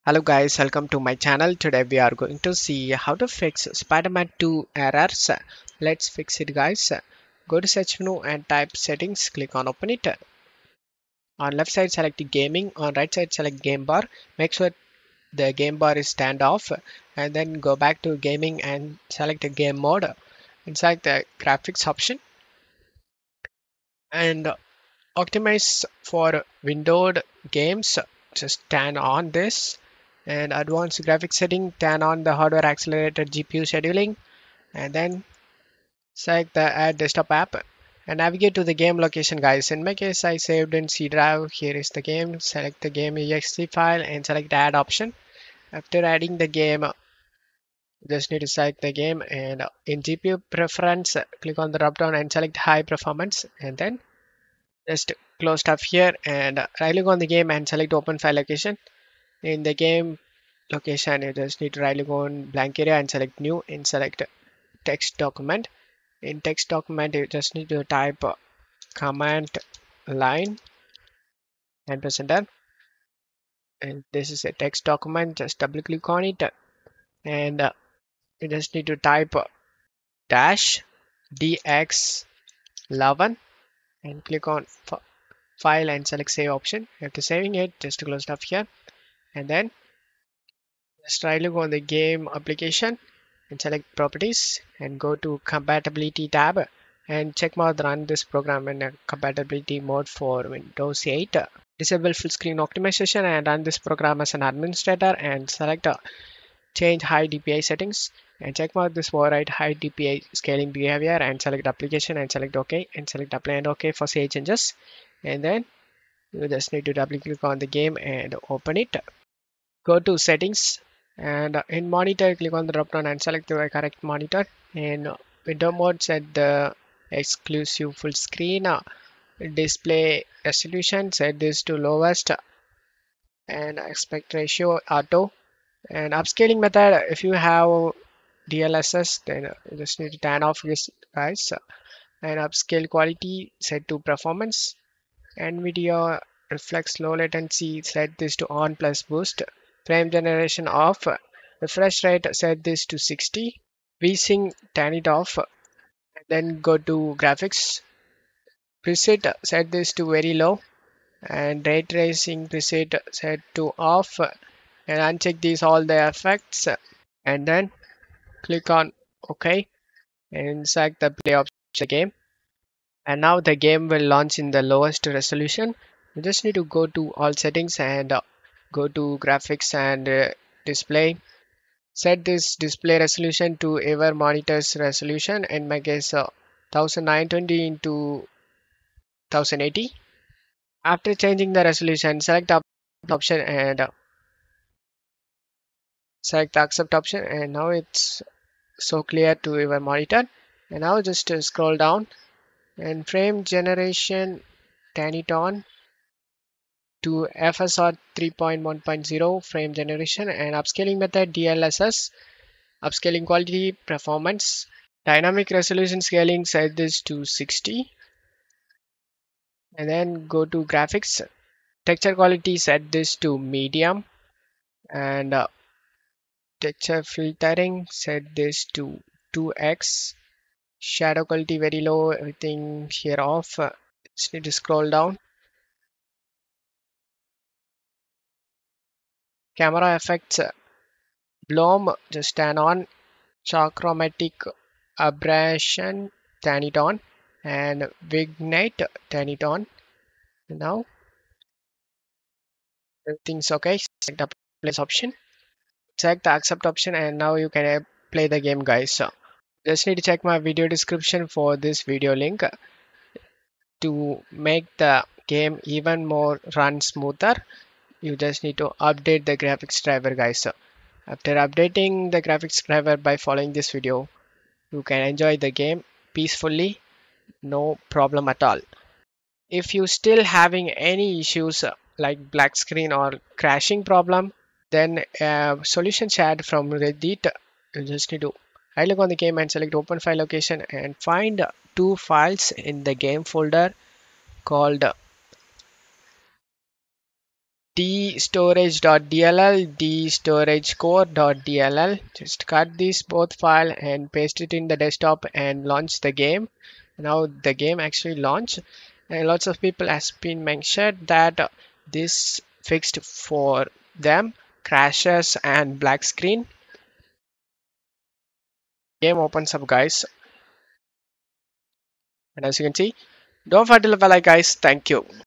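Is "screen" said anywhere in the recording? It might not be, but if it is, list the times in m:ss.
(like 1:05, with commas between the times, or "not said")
1:42, 2:08, 4:42, 5:16.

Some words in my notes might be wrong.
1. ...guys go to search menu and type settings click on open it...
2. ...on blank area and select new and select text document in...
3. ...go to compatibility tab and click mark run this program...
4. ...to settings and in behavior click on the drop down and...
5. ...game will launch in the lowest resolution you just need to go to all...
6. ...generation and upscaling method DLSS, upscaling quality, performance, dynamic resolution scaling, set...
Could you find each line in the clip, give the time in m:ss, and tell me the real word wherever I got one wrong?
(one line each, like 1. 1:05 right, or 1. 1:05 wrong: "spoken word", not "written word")
1. 0:06 right
2. 1:02 right
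3. 1:34 wrong: "check", not "click"
4. 1:59 wrong: "monitor", not "behavior"
5. 2:53 right
6. 3:29 right.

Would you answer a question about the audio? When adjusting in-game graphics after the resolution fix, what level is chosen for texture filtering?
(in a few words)
2x.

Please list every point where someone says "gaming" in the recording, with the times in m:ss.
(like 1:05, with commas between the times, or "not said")
0:12, 0:18.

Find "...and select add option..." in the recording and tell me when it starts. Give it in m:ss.
0:44.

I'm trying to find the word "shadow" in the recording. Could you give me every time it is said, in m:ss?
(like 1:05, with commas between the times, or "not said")
3:50.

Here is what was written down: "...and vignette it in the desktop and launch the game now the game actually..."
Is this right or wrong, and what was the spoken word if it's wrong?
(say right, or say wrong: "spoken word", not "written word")
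wrong: "paste", not "vignette".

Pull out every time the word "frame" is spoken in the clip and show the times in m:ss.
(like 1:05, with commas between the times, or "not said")
2:29, 3:23, 3:29.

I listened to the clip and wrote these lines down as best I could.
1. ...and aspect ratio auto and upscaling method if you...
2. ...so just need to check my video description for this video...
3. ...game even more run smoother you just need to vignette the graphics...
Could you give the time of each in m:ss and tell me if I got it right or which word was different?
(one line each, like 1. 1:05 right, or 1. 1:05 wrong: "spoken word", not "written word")
1. 2:13 right
2. 4:18 right
3. 4:25 wrong: "update", not "vignette".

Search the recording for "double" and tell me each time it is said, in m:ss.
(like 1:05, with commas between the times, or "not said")
1:15, 1:56.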